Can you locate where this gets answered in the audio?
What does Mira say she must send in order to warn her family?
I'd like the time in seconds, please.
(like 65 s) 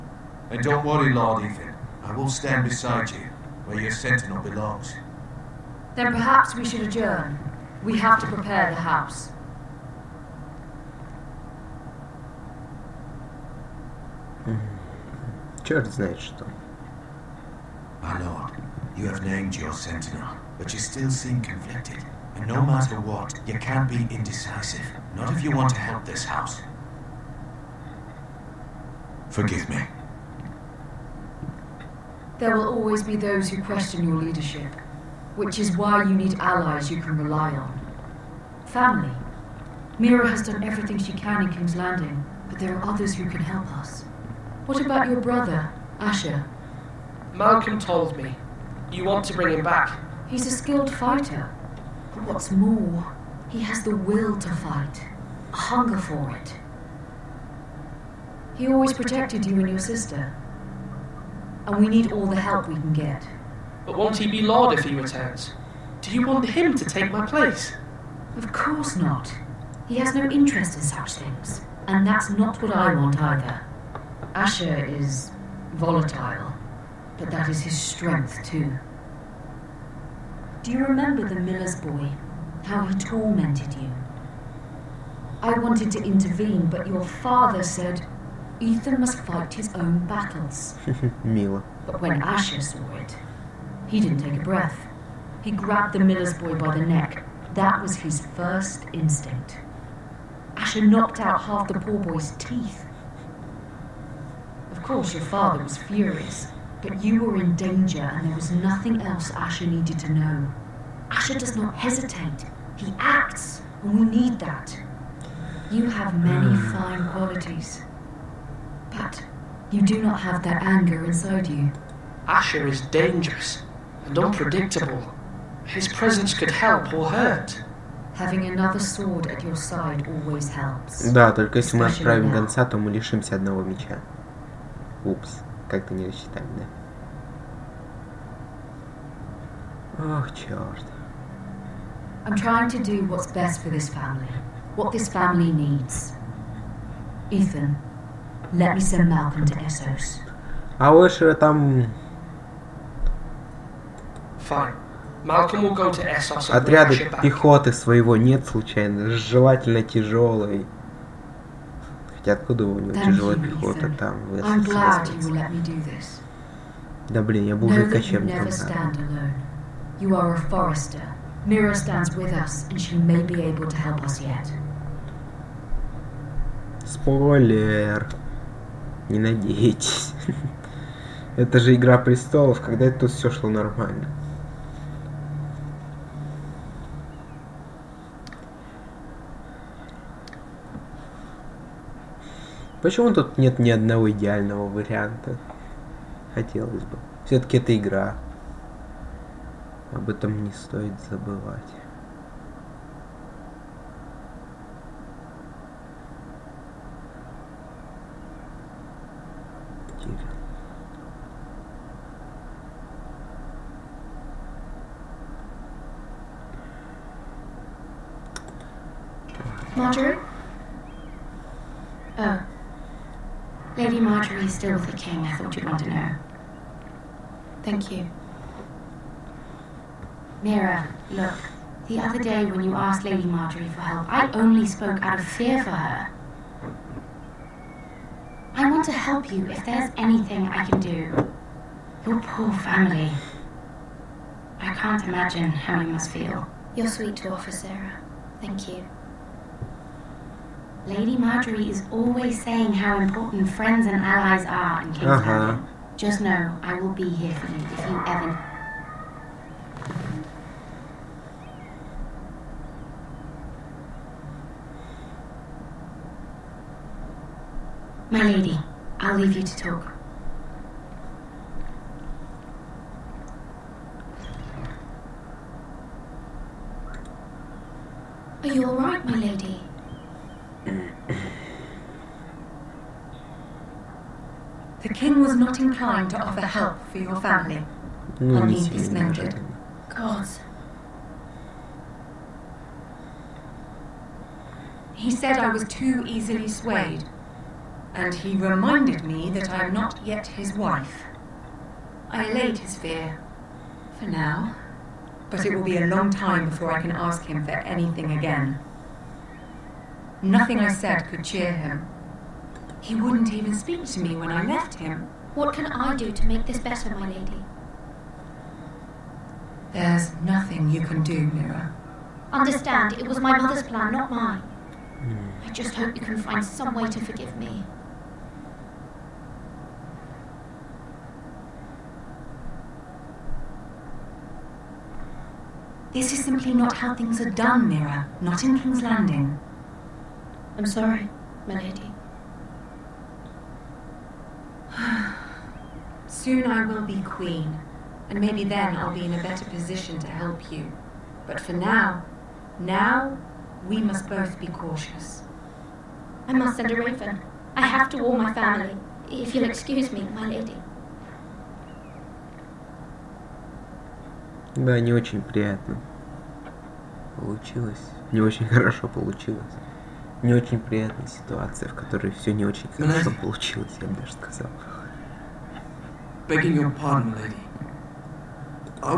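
356 s.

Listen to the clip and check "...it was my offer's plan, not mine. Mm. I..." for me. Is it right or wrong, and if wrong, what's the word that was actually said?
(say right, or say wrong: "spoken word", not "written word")
wrong: "mother", not "offer".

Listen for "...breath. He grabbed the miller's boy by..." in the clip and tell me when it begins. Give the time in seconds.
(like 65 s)
94 s.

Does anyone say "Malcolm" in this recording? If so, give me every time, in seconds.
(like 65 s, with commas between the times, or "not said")
47 s, 149 s, 155 s.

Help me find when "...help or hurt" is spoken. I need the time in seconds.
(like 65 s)
126 s.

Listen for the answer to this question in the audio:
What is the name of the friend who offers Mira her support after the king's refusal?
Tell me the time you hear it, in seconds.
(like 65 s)
247 s.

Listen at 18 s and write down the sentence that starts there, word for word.
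My lord, you have named your sentinel, but you still seem conflicted no matter what, you can't be indecisive.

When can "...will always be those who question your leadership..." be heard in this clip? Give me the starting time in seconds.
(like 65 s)
32 s.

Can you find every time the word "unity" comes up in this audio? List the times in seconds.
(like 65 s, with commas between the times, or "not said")
not said.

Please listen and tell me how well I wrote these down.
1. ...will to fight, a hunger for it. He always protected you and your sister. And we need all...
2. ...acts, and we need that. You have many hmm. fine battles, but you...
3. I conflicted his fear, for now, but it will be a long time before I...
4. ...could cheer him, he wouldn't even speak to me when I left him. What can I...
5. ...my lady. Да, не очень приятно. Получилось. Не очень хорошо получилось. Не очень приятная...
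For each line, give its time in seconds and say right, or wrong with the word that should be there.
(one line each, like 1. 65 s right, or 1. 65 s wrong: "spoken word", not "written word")
1. 53 s right
2. 112 s wrong: "qualities", not "battles"
3. 302 s wrong: "allayed", not "conflicted"
4. 311 s right
5. 360 s right.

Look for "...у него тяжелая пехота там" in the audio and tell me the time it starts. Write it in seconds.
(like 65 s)
162 s.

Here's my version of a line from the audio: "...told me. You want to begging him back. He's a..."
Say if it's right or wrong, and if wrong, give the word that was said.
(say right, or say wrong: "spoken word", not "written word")
wrong: "bring", not "begging".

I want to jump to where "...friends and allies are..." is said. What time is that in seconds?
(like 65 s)
253 s.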